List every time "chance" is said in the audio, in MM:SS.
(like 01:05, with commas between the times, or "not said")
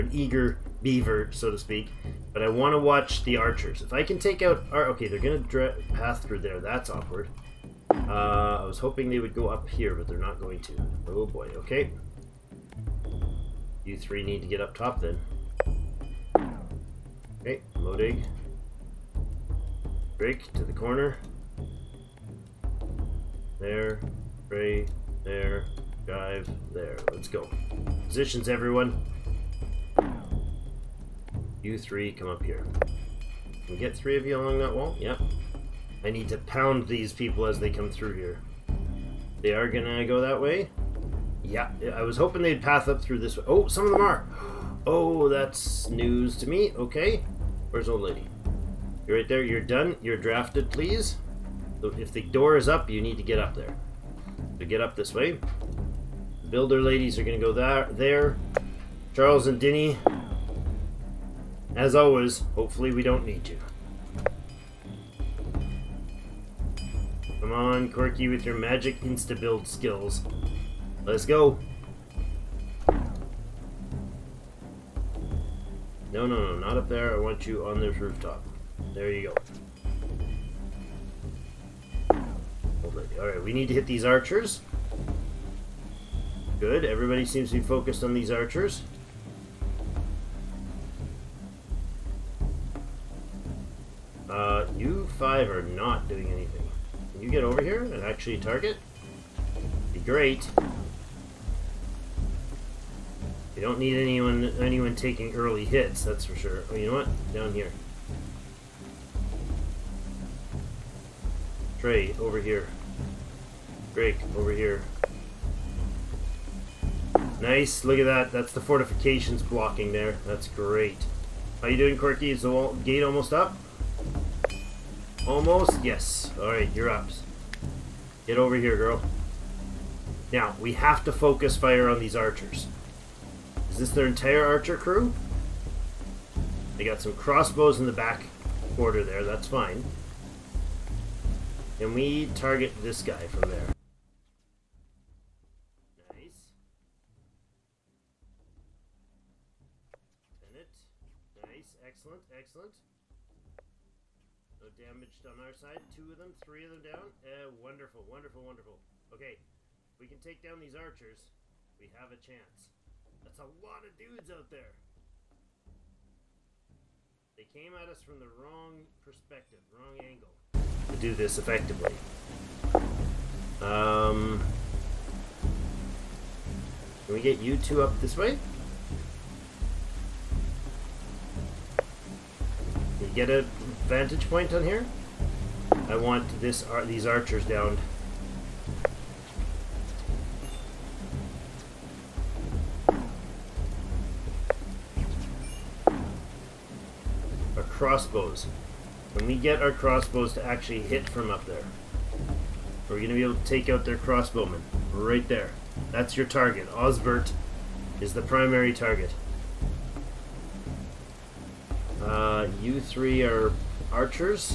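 02:42.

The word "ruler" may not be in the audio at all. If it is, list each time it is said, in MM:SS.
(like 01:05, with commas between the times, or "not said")
not said.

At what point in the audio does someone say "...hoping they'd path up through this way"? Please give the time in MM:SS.
00:42.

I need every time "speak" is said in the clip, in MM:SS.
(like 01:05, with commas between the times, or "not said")
00:01.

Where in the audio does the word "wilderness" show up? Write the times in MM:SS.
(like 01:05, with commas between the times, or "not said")
not said.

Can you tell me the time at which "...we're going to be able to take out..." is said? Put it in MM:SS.
03:22.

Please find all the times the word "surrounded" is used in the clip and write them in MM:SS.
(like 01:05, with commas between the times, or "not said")
not said.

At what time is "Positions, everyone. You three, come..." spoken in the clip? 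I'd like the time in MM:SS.
00:28.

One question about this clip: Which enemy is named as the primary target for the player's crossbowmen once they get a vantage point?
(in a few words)
Osbert.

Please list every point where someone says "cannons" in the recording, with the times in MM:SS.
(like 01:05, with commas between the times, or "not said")
not said.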